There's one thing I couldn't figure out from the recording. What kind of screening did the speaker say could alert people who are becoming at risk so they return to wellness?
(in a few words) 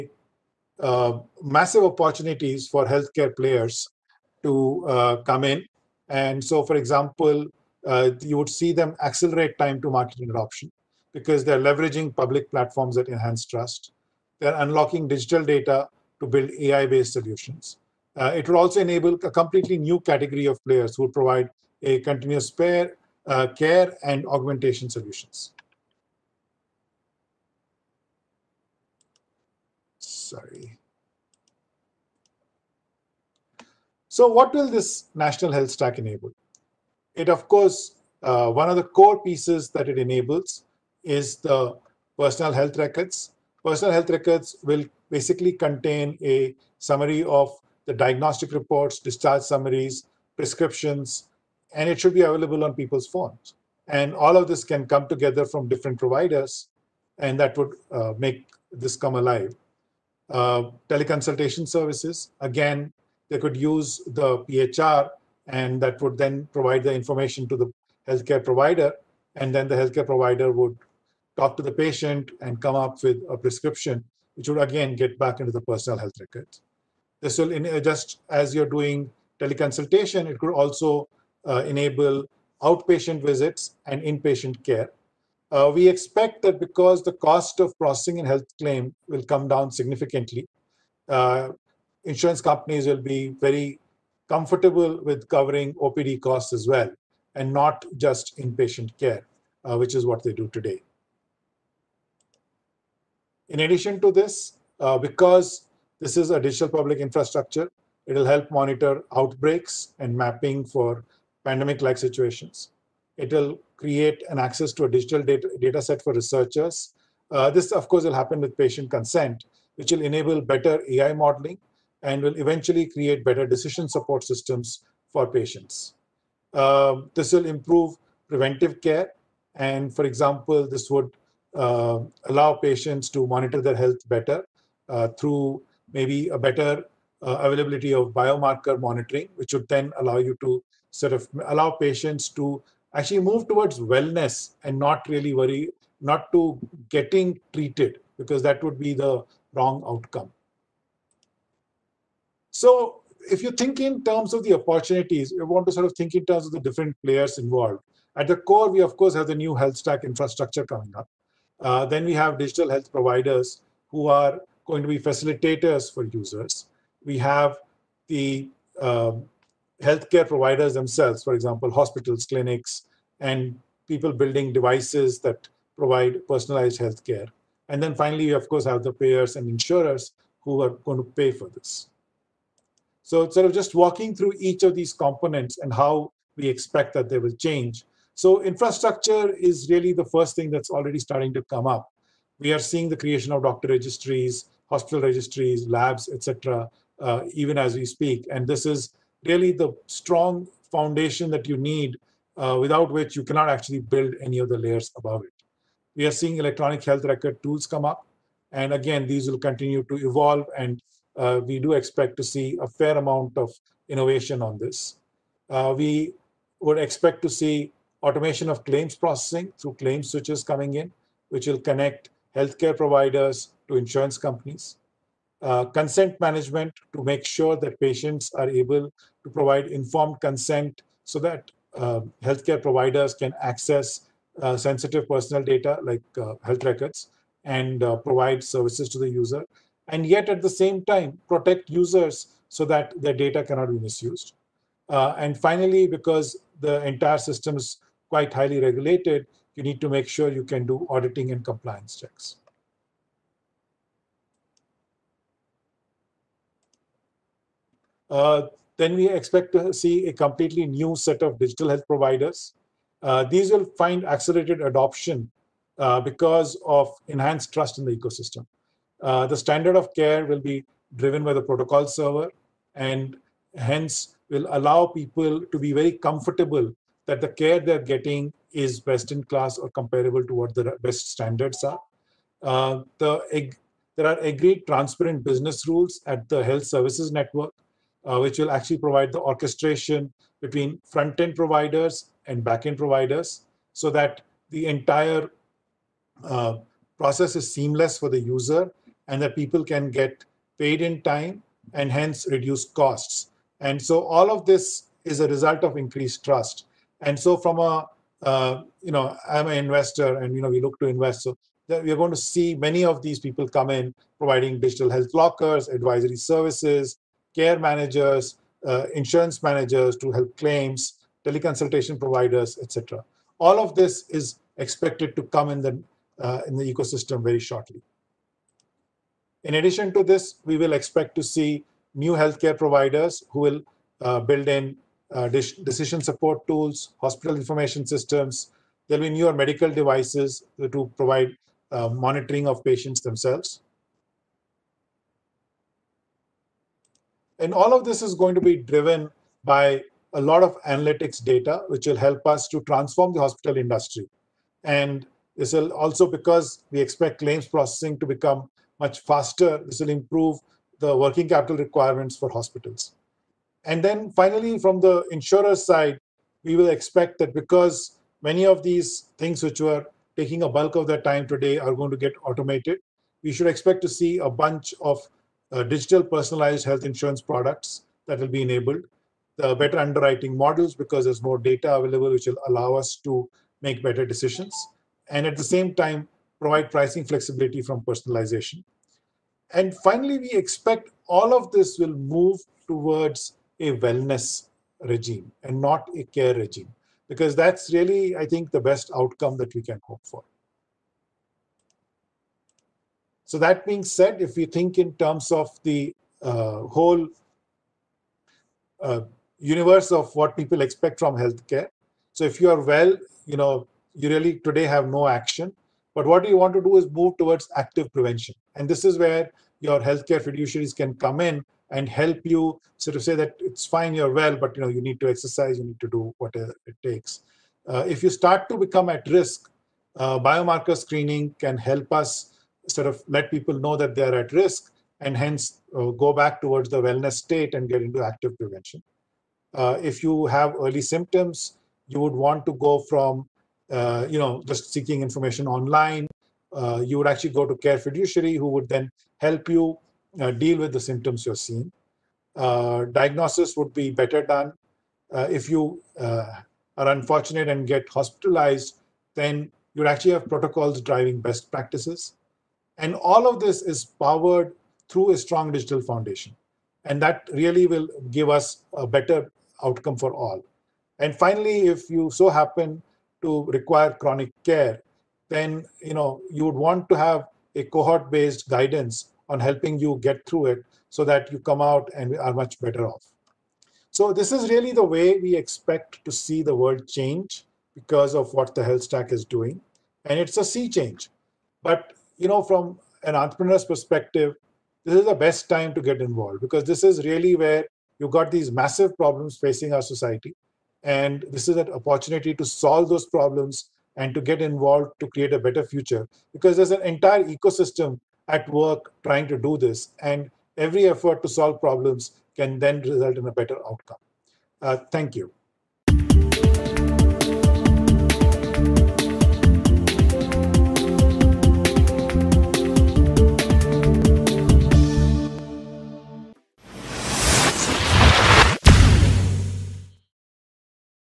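Biomarker screening.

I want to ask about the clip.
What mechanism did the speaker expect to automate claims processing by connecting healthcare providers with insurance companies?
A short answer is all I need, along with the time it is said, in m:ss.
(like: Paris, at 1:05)
Claim switches, at 3:39.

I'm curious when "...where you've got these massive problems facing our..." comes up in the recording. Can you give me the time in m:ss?
8:17.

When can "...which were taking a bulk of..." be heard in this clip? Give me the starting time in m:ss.
6:09.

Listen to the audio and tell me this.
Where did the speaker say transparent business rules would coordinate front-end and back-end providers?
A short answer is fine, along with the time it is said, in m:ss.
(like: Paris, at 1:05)
Health services network, at 4:46.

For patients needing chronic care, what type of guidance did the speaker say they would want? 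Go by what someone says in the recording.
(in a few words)
Cohort-based guidance.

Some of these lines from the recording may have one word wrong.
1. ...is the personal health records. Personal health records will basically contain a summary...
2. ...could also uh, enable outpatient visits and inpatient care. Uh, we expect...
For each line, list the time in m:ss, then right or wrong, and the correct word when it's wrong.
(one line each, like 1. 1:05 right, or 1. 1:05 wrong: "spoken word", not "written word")
1. 0:41 right
2. 1:20 right.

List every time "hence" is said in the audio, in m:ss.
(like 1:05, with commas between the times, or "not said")
4:33, 5:01, 7:15.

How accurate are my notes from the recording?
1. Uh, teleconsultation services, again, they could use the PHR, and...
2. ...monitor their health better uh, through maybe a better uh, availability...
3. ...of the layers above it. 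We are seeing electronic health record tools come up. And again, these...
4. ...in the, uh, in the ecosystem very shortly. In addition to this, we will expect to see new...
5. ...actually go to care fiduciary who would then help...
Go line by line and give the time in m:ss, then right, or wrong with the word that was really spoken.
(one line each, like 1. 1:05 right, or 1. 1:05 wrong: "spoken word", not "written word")
1. 1:00 right
2. 2:13 right
3. 3:24 right
4. 5:25 right
5. 7:27 right.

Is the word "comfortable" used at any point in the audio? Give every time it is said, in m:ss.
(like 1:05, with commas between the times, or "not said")
1:34, 4:36.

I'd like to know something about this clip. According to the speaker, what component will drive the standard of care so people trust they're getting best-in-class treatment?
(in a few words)
The protocol server.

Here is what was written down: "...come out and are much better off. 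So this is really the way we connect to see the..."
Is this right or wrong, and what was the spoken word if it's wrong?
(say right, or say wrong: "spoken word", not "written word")
wrong: "expect", not "connect".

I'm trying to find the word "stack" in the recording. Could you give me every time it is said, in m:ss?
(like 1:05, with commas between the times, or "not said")
0:35, 2:39, 8:08.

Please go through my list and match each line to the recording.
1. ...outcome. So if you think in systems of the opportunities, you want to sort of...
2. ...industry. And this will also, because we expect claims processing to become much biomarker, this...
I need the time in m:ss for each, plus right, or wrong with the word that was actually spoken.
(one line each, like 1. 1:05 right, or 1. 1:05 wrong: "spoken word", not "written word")
1. 2:29 wrong: "terms", not "systems"
2. 5:53 wrong: "faster", not "biomarker".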